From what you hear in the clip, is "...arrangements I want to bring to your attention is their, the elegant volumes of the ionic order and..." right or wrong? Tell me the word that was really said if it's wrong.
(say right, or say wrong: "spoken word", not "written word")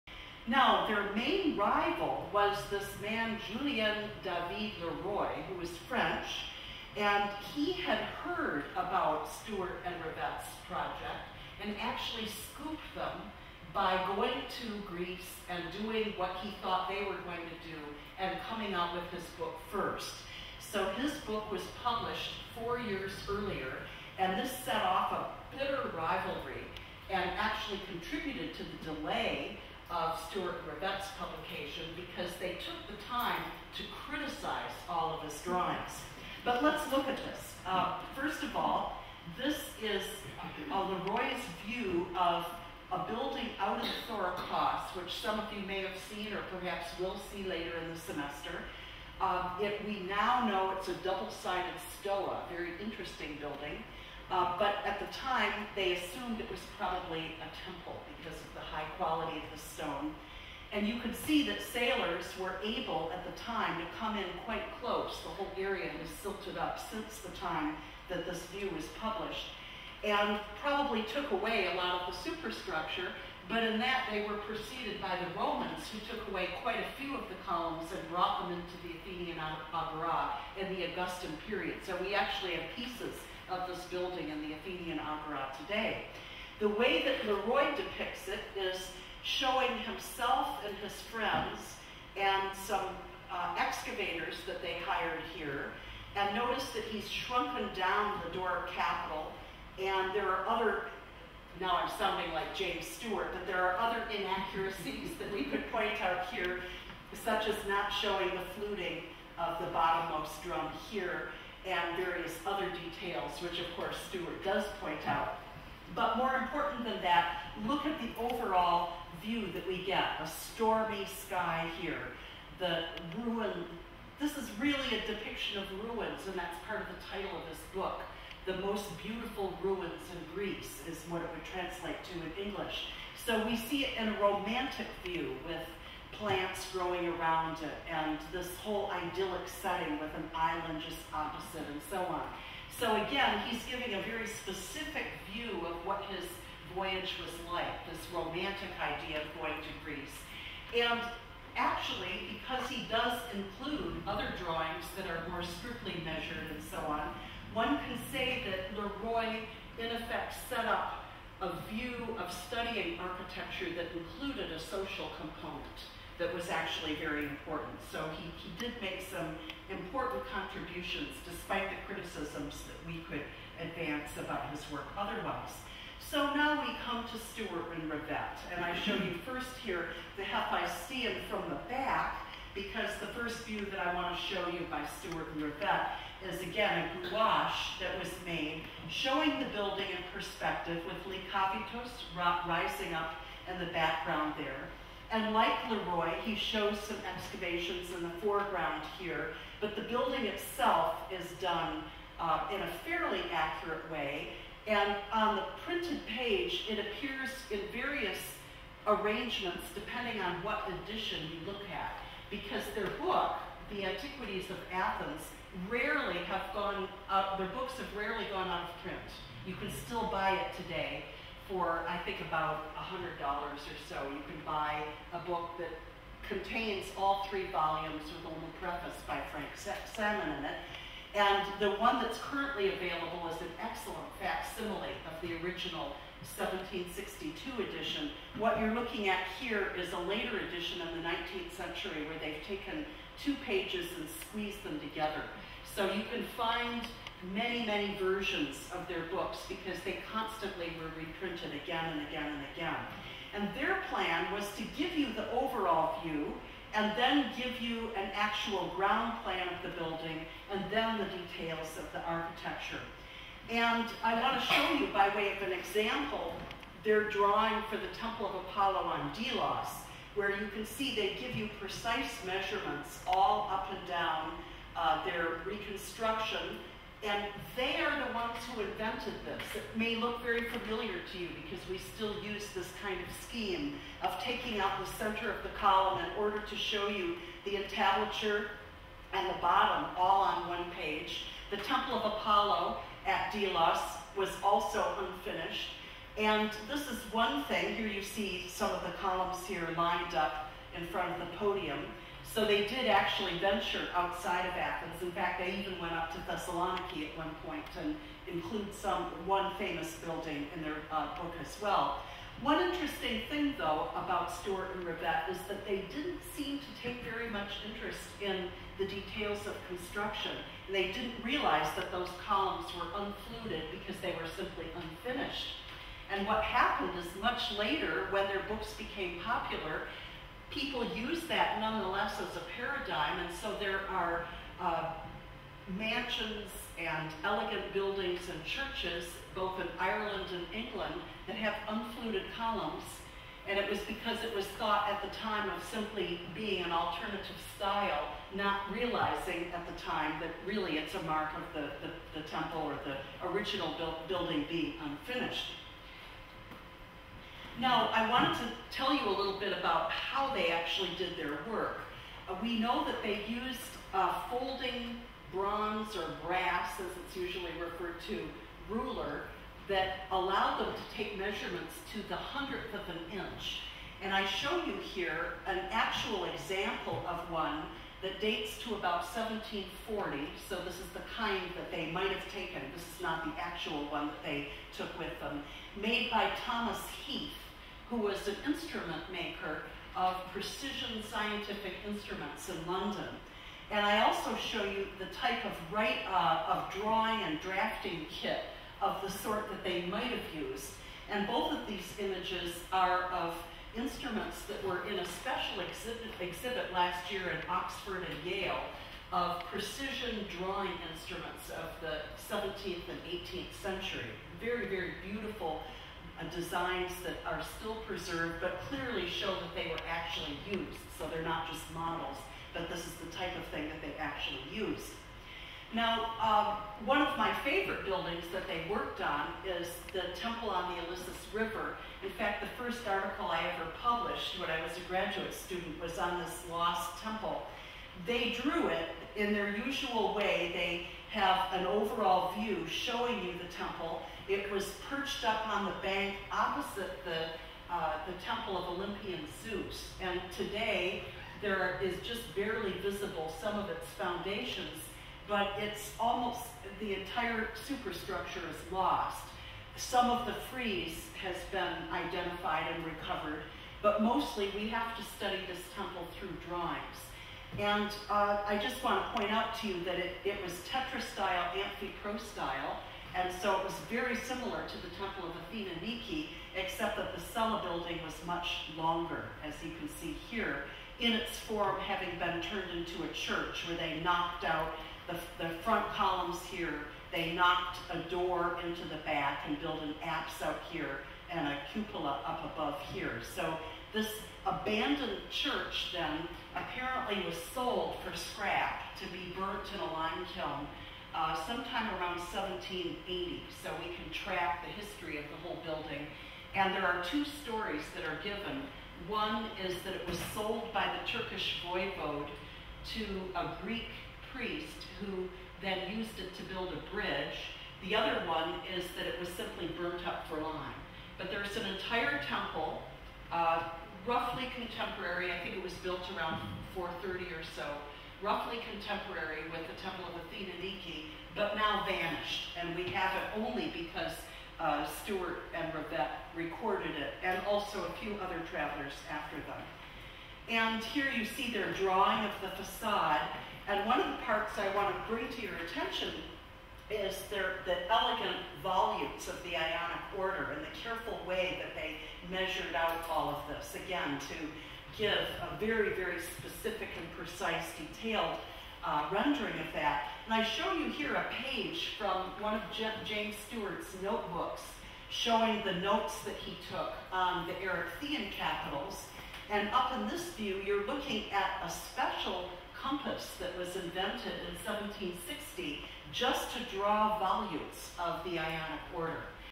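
wrong: "parts", not "arrangements".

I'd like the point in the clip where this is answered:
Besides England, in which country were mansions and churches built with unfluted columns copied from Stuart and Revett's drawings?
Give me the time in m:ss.
5:39.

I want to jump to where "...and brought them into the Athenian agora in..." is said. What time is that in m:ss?
1:17.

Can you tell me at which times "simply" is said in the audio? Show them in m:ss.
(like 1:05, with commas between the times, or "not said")
5:24, 5:45, 8:39.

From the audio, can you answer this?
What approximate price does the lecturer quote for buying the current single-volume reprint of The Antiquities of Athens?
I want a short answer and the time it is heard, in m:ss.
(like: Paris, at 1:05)
$100, at 3:42.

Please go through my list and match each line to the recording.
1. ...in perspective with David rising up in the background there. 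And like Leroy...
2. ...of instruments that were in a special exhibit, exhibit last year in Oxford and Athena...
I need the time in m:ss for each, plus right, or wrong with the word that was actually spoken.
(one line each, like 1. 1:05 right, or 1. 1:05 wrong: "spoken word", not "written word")
1. 3:09 wrong: "Likavitos", not "David"
2. 6:43 wrong: "Yale", not "Athena".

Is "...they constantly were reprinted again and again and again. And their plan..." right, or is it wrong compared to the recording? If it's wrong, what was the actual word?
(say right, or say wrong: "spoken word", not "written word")
right.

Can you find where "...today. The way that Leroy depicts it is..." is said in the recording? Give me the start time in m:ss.
1:25.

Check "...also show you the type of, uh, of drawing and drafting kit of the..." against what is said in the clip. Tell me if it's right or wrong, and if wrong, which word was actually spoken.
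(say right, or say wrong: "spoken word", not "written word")
right.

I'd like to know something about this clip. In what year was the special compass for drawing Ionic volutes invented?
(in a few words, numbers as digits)
1760.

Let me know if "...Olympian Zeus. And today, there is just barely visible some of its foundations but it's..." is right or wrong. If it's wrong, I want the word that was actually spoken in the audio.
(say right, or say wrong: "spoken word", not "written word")
right.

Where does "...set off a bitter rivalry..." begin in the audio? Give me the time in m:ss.
0:24.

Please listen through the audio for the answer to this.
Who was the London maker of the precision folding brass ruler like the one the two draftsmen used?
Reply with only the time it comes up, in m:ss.
6:26.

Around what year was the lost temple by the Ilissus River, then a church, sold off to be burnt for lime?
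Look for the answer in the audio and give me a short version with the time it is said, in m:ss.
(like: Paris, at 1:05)
1780, at 8:22.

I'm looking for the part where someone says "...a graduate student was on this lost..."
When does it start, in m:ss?
7:14.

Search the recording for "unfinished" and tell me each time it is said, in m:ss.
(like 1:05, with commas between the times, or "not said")
4:54, 5:24, 5:54.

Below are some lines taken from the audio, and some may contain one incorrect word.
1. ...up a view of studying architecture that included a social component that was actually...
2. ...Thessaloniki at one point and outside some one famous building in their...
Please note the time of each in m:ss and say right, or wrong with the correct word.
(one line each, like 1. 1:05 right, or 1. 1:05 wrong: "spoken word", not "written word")
1. 2:40 right
2. 5:06 wrong: "include", not "outside".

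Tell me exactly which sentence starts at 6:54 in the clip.
Very, very beautiful uh, designs that are still preserved, but clearly show that they were actually used.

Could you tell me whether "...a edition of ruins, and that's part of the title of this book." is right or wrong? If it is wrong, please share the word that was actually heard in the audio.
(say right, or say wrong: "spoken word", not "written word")
wrong: "depiction", not "edition".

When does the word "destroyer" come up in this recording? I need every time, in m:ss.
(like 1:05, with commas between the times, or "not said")
not said.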